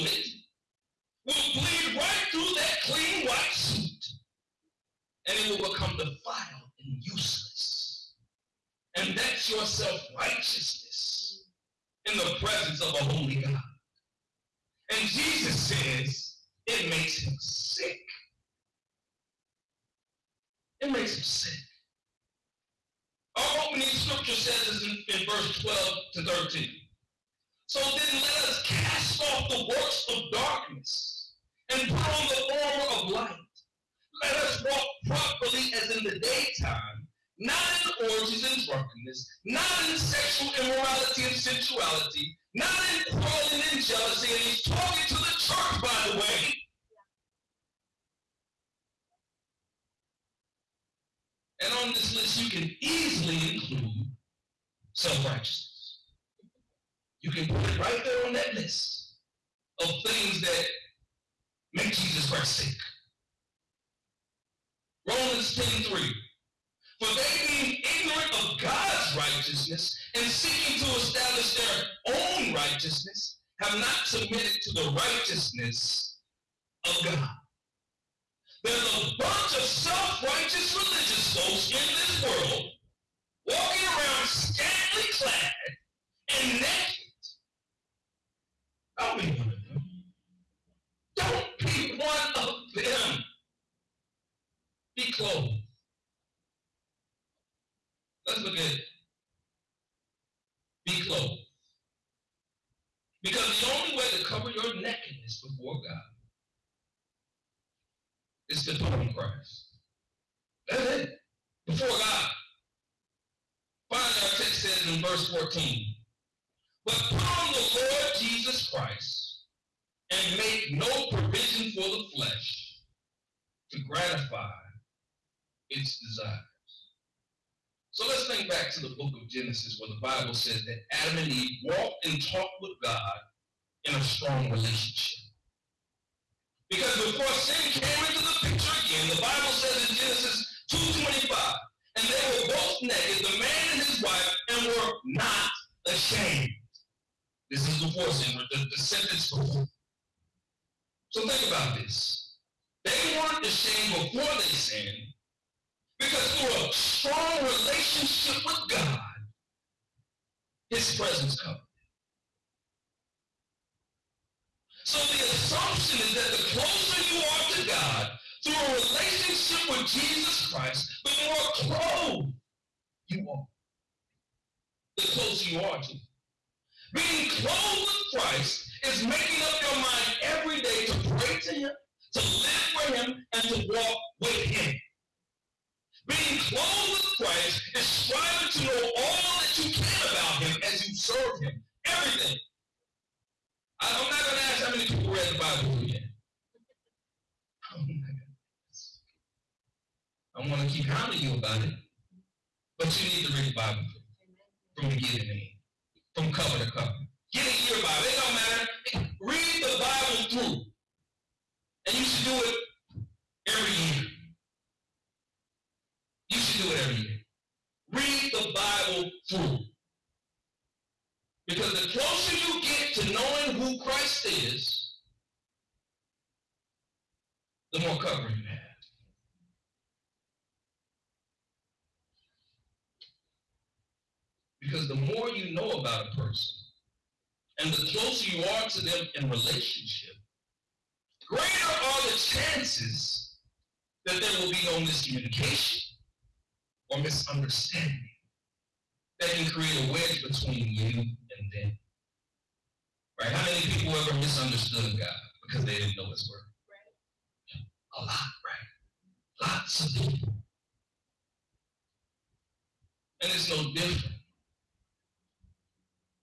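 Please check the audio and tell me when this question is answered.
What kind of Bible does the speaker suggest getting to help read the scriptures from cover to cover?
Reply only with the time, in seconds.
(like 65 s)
207 s.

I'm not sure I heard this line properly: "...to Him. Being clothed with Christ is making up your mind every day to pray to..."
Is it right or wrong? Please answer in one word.
right.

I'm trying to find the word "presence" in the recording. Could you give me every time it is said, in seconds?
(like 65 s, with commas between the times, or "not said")
12 s, 160 s.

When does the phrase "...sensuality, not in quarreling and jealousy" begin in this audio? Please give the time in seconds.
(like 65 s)
41 s.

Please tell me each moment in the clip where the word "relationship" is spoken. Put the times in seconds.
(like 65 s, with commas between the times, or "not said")
134 s, 157 s, 168 s, 239 s.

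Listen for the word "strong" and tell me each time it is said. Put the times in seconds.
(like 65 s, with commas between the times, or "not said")
134 s, 156 s.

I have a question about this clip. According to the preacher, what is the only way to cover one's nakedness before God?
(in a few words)
Put on Christ.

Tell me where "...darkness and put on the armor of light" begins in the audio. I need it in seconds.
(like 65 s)
30 s.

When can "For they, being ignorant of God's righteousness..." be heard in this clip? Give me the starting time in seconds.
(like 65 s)
66 s.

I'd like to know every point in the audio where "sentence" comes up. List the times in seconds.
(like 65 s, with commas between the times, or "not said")
148 s.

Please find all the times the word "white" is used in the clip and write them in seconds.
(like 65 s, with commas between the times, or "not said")
3 s.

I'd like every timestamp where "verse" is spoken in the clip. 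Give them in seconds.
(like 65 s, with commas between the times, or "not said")
25 s, 115 s.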